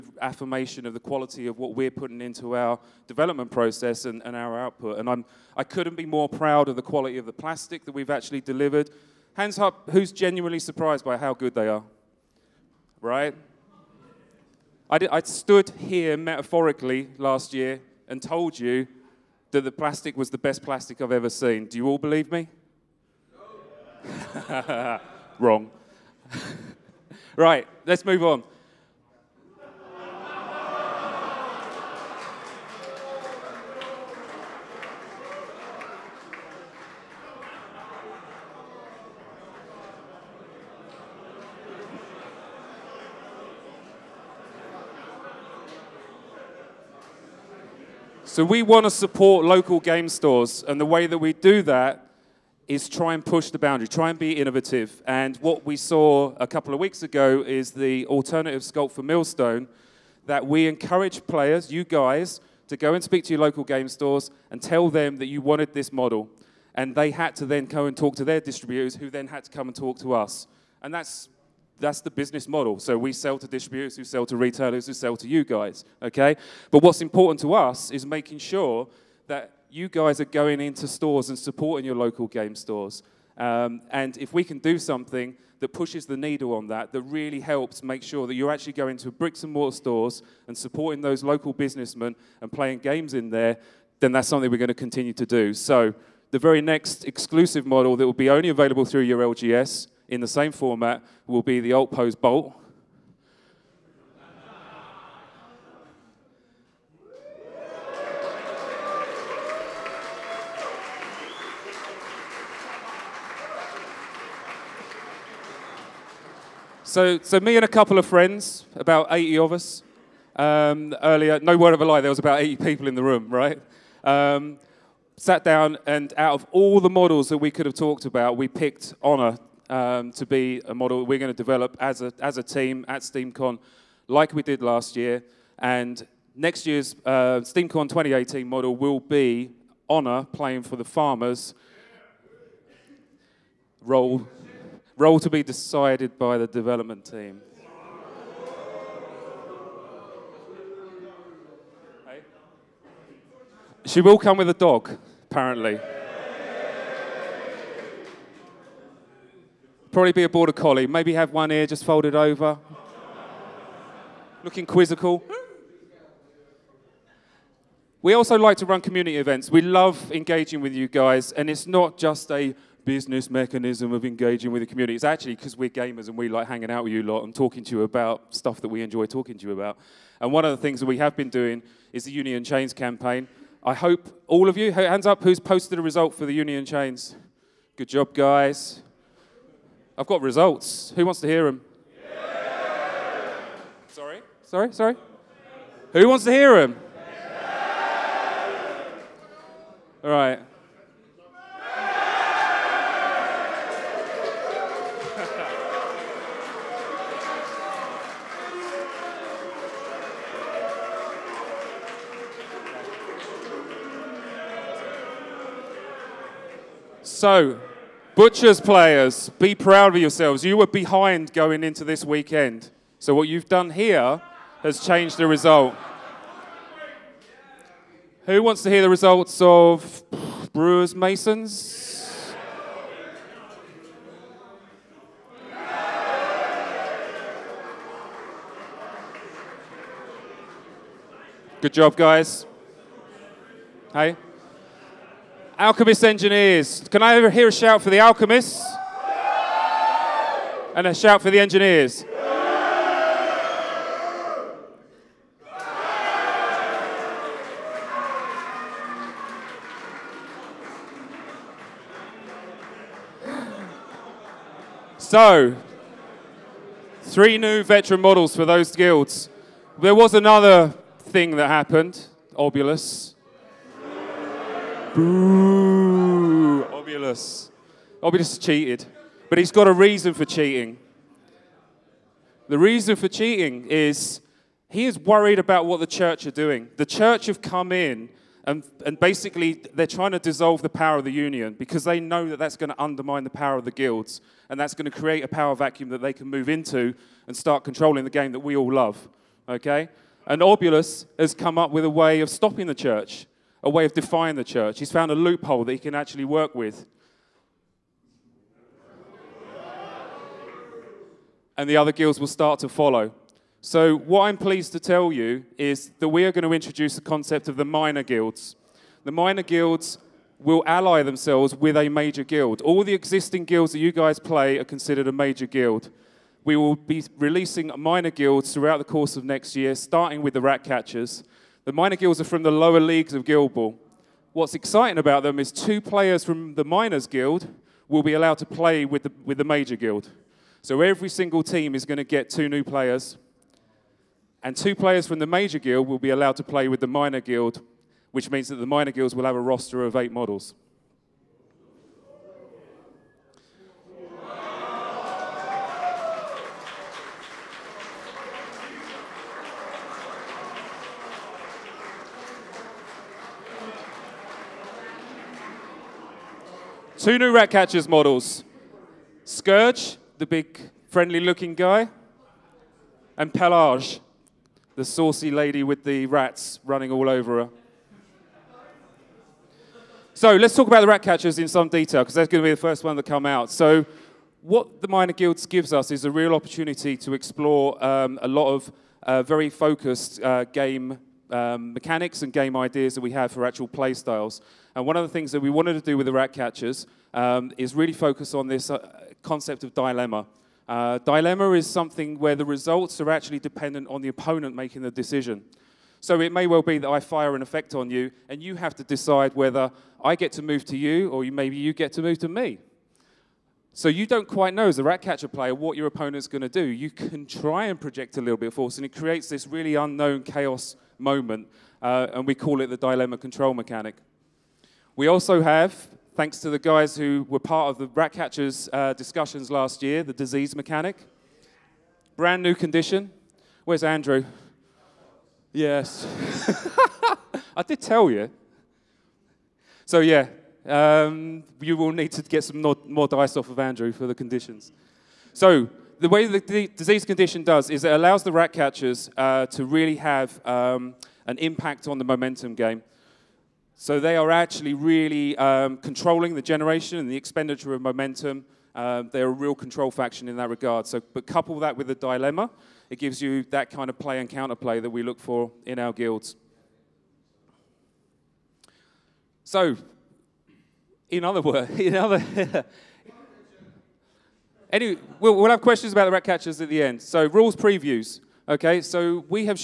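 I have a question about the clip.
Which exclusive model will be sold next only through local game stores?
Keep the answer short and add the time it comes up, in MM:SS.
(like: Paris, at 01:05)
alt pose Bolt, at 01:41.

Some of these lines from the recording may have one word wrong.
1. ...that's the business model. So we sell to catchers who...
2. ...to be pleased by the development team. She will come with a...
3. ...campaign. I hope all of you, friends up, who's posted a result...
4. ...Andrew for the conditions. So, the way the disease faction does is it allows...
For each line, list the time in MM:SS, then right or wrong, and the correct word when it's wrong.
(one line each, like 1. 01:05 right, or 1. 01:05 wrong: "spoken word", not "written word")
1. 01:11 wrong: "distributors", not "catchers"
2. 02:25 wrong: "decided", not "pleased"
3. 03:02 wrong: "hands", not "friends"
4. 07:23 wrong: "condition", not "faction".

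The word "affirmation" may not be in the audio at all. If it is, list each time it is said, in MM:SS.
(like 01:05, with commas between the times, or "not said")
00:00.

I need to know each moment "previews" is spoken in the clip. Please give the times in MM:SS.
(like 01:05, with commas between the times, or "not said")
07:57.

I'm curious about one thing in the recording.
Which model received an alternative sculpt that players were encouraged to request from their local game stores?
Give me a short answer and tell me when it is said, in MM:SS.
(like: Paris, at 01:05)
Millstone, at 00:59.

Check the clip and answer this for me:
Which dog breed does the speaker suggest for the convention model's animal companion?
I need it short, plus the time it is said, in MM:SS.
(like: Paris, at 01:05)
border collie, at 02:40.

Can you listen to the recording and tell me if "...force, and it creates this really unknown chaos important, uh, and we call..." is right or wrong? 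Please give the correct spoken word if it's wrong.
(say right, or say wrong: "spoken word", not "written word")
wrong: "moment", not "important".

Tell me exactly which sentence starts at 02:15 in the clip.
And next year's uh, SteamCon 2018 model will be Honor playing for the farmers.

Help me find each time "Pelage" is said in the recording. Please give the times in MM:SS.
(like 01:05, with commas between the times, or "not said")
06:13.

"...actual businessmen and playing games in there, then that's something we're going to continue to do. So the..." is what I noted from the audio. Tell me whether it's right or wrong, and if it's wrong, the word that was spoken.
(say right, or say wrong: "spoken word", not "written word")
wrong: "local", not "actual".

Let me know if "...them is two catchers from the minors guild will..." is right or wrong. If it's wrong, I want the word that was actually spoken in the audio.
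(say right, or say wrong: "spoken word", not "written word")
wrong: "players", not "catchers".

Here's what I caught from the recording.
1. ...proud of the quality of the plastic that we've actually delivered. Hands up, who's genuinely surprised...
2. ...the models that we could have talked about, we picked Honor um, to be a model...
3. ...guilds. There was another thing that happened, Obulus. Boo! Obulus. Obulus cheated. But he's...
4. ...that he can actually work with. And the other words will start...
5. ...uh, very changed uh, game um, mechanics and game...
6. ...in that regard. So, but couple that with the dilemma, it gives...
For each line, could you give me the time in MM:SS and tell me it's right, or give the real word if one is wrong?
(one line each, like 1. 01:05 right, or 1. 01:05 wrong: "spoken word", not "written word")
1. 00:06 right
2. 02:06 right
3. 04:28 right
4. 05:05 wrong: "guilds", not "words"
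5. 06:29 wrong: "focused", not "changed"
6. 07:40 right.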